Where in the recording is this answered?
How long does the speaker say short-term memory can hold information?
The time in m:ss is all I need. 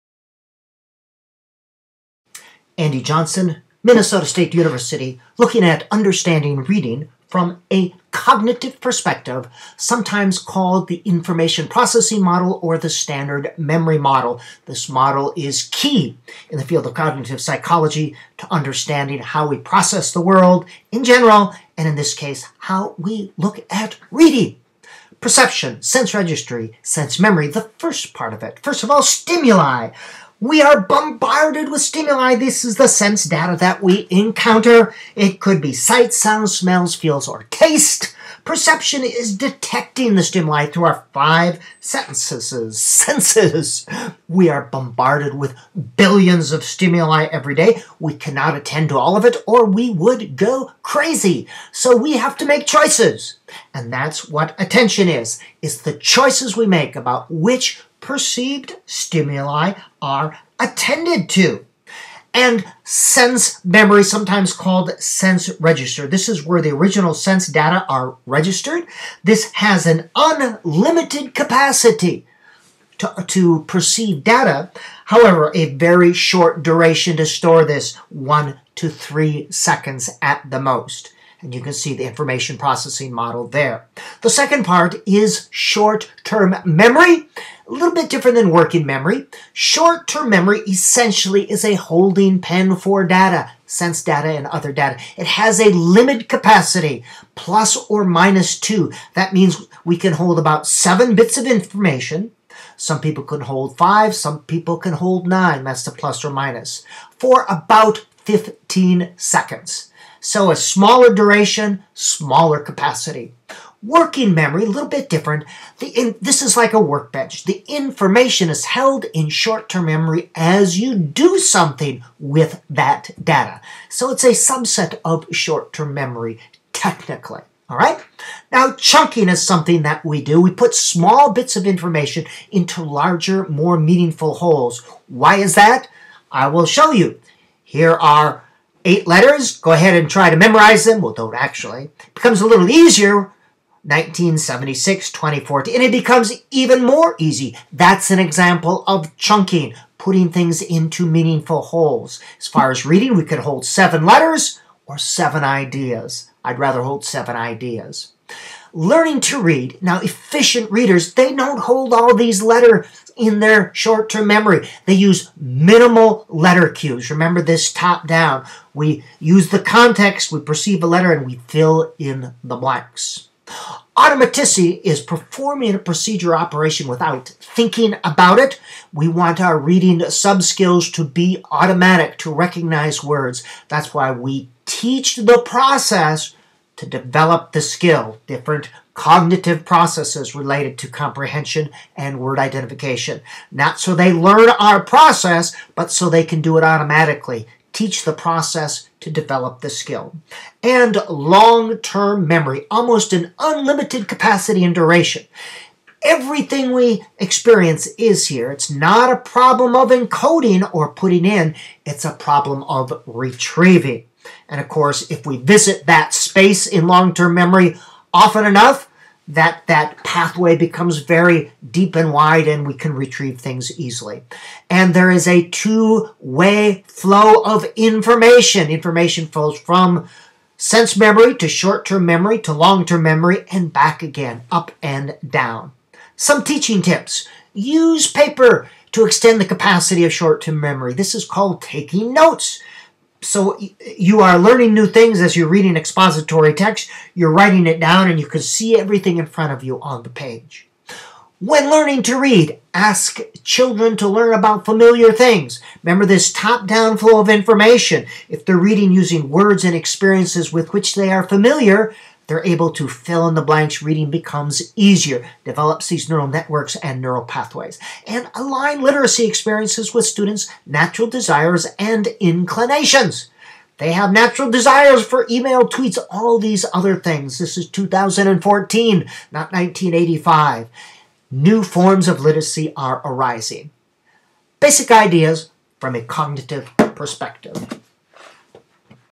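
1:48.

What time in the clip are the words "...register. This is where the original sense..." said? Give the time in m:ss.
1:05.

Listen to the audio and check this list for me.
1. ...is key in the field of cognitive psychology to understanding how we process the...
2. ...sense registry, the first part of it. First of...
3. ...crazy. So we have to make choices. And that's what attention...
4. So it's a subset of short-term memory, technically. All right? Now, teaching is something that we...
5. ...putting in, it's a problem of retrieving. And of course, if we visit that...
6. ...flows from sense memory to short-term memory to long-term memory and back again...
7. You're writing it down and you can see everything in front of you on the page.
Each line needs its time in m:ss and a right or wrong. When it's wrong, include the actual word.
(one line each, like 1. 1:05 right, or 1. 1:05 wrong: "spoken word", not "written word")
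1. 0:15 right
2. 0:26 wrong: "memory", not "registry"
3. 0:50 right
4. 2:03 wrong: "chunking", not "teaching"
5. 3:30 right
6. 3:49 right
7. 4:07 right.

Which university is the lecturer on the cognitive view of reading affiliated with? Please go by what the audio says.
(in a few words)
Minnesota State University.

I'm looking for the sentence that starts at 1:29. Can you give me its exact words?
Short-term memory essentially is a holding pen for data, sense data and other data.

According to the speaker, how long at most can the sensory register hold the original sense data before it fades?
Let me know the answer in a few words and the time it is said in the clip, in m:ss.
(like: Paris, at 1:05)
1 to 3 seconds, at 1:18.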